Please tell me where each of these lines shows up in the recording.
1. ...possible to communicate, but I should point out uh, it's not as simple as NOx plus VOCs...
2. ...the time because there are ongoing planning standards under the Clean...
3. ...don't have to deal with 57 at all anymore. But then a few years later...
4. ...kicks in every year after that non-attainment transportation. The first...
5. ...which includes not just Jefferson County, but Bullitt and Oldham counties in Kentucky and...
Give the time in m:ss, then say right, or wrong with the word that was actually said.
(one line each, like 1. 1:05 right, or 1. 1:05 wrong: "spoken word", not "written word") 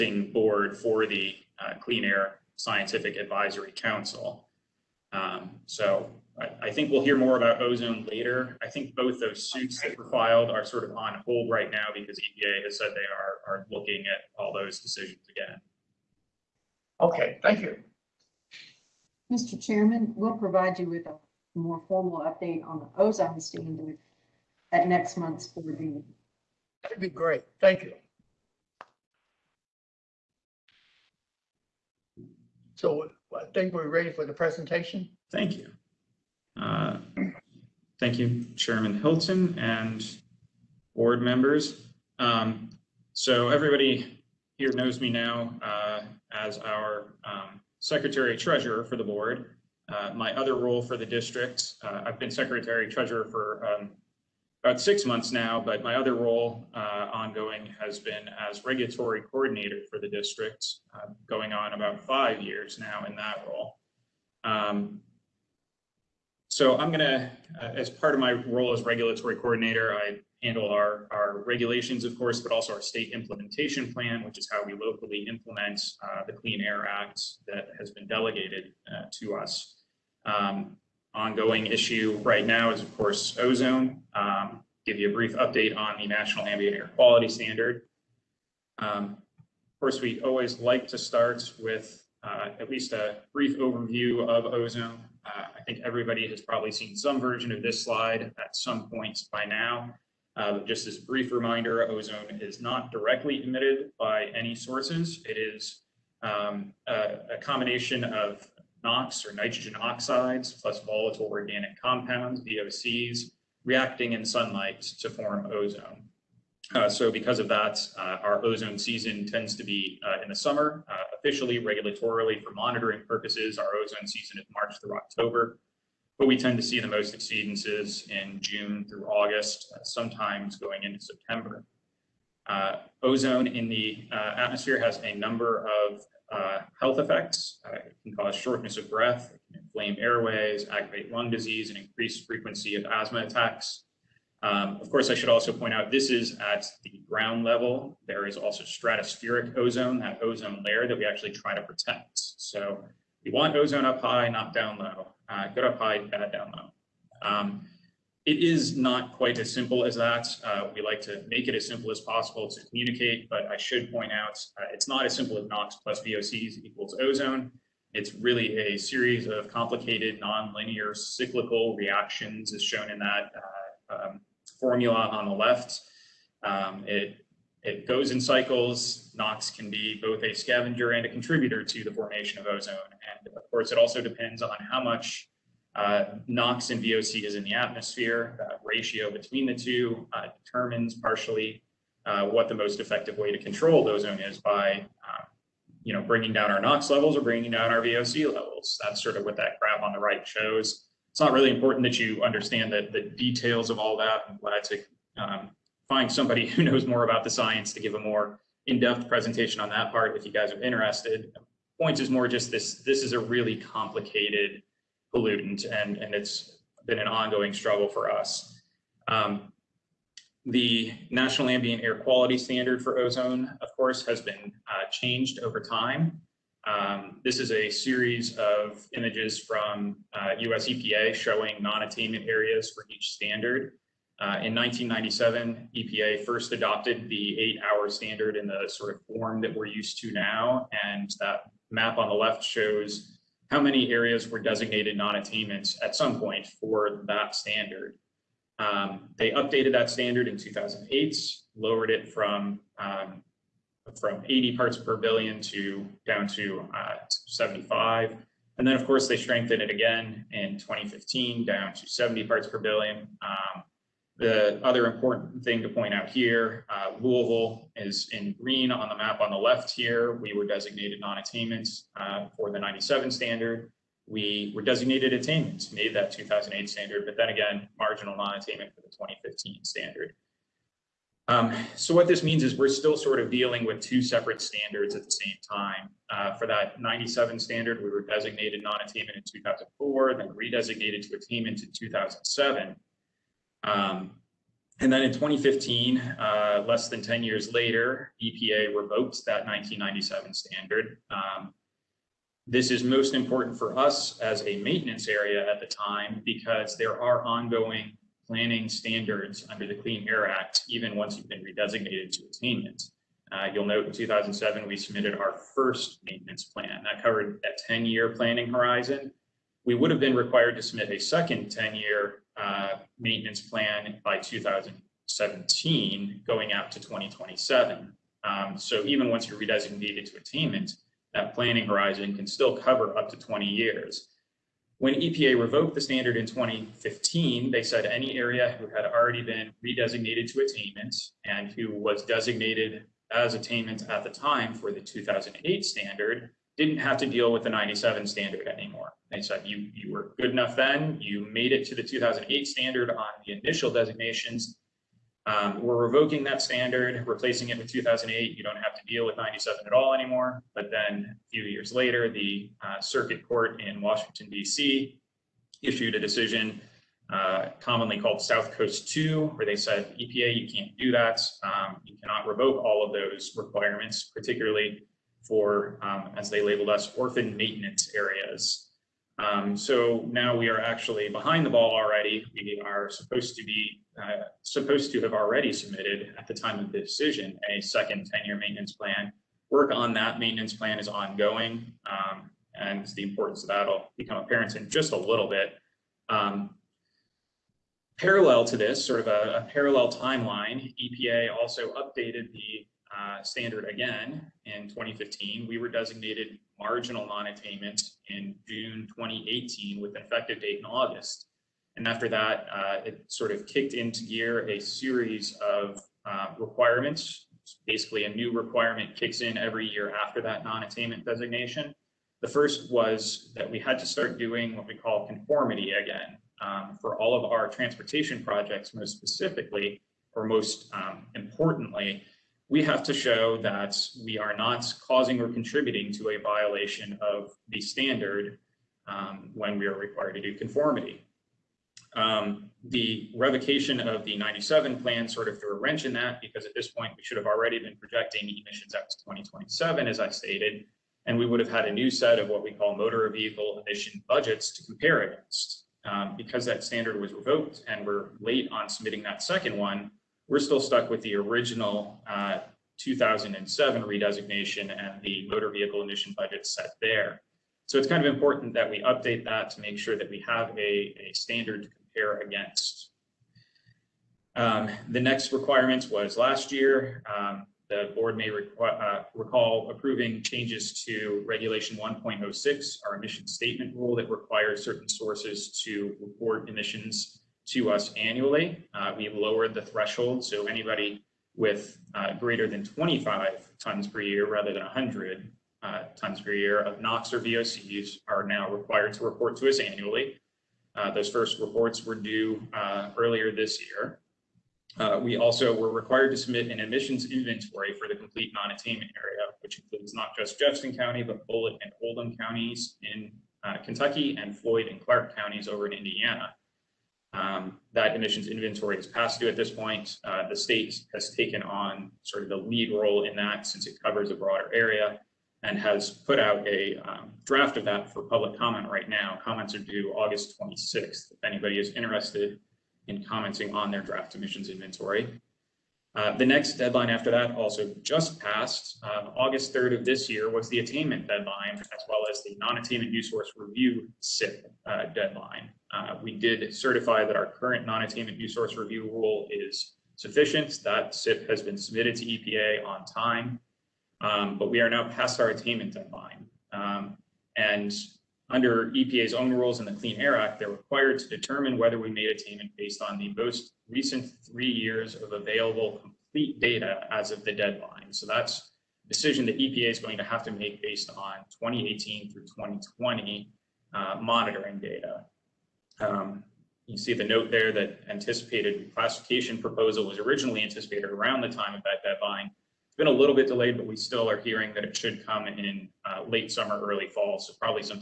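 1. 2:41 right
2. 5:05 right
3. 5:58 wrong: "97", not "57"
4. 6:58 wrong: "designation", not "transportation"
5. 8:29 right.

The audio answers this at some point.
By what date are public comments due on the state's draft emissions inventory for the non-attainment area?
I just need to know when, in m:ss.
8:49.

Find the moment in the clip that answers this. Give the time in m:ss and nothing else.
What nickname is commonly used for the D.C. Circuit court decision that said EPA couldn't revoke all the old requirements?
6:08.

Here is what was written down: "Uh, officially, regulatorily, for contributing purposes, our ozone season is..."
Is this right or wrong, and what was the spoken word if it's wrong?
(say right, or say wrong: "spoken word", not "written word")
wrong: "monitoring", not "contributing".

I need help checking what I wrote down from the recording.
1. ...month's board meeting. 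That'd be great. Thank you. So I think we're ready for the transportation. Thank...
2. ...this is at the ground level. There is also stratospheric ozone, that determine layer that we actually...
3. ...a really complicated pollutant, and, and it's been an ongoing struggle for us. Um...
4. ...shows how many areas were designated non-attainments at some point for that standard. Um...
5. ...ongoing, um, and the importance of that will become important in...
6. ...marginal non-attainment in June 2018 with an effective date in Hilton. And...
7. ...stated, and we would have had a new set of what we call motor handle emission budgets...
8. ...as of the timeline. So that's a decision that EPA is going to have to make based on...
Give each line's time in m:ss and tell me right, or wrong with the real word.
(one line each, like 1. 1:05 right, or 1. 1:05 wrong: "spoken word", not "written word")
1. 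0:25 wrong: "presentation", not "transportation"
2. 2:25 wrong: "ozone", not "determine"
3. 3:33 right
4. 4:02 right
5. 6:30 wrong: "apparent", not "important"
6. 6:46 wrong: "August", not "Hilton"
7. 7:30 wrong: "vehicle", not "handle"
8. 9:26 wrong: "deadline", not "timeline".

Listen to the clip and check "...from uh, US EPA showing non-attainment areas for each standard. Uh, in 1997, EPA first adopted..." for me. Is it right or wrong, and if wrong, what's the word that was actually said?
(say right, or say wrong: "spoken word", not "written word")
right.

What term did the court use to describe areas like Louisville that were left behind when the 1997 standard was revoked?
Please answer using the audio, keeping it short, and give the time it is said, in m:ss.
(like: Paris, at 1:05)
orphan maintenance areas, at 6:16.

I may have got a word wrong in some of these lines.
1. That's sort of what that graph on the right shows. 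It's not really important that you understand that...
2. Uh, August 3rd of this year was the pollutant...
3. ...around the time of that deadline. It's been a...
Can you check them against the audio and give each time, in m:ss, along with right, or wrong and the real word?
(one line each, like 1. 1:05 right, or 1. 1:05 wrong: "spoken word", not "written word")
1. 3:18 right
2. 8:58 wrong: "attainment", not "pollutant"
3. 9:40 right.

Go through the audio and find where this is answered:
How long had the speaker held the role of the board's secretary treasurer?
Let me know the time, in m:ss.
0:54.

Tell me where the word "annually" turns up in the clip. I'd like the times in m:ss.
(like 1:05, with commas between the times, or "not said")
8:07, 8:19.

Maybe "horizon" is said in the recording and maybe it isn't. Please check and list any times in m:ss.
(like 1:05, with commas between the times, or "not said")
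5:18, 5:31.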